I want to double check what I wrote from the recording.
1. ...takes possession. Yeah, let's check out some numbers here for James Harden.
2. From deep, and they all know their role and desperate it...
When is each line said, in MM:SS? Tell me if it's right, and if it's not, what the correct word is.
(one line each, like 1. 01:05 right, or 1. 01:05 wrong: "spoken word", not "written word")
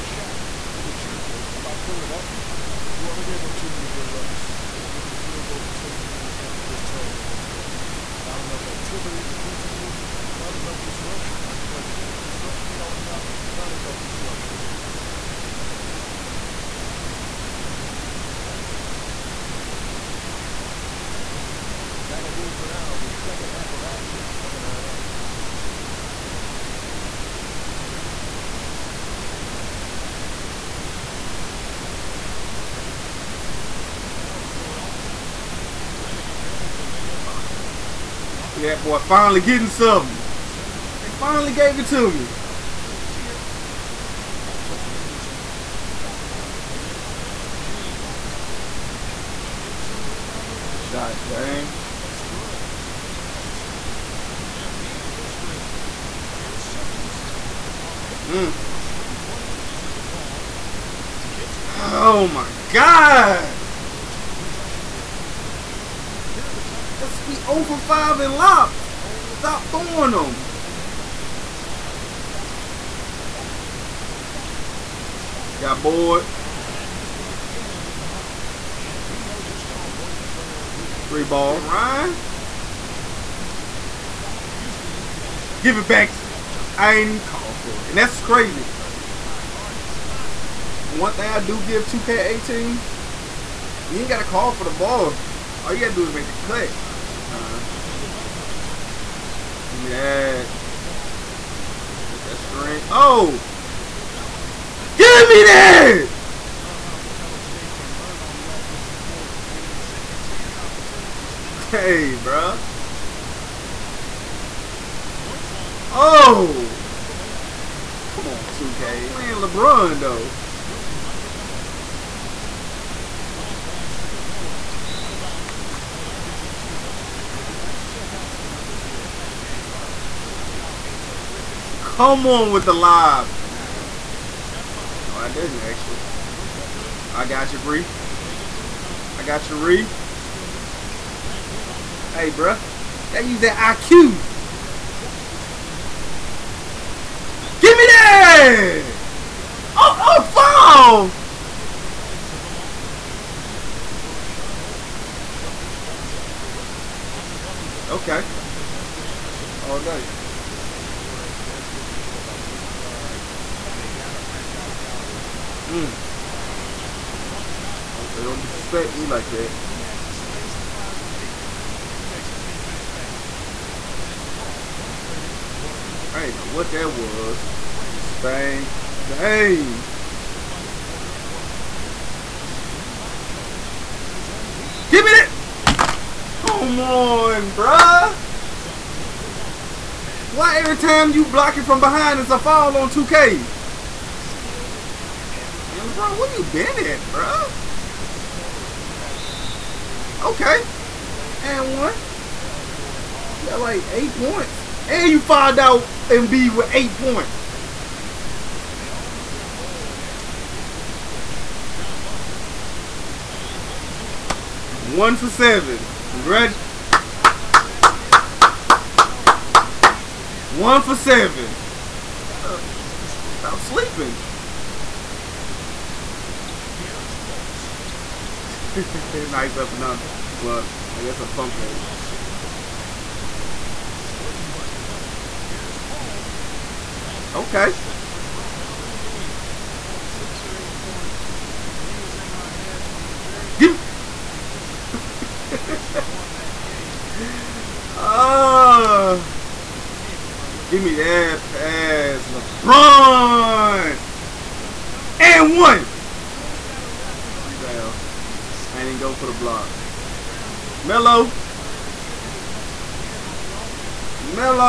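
1. 02:06 right
2. 03:27 wrong: "execute", not "desperate".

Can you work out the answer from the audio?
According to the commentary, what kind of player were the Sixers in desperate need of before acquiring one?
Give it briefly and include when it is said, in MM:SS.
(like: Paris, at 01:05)
A lead guard, at 02:42.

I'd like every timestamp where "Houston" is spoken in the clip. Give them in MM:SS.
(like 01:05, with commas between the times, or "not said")
01:16, 01:24.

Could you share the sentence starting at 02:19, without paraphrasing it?
Oh, gets to Banked in off the glass.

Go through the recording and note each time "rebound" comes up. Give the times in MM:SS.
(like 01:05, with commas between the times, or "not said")
02:18, 04:17.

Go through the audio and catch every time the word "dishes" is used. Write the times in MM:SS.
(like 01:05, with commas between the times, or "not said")
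00:59.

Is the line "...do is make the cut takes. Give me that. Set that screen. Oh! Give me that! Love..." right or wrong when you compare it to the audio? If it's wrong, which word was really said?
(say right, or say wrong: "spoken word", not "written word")
wrong: "sometimes", not "takes".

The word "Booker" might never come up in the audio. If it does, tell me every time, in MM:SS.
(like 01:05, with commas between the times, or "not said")
02:16, 02:36.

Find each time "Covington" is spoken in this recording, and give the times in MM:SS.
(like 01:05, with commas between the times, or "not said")
00:36, 02:37.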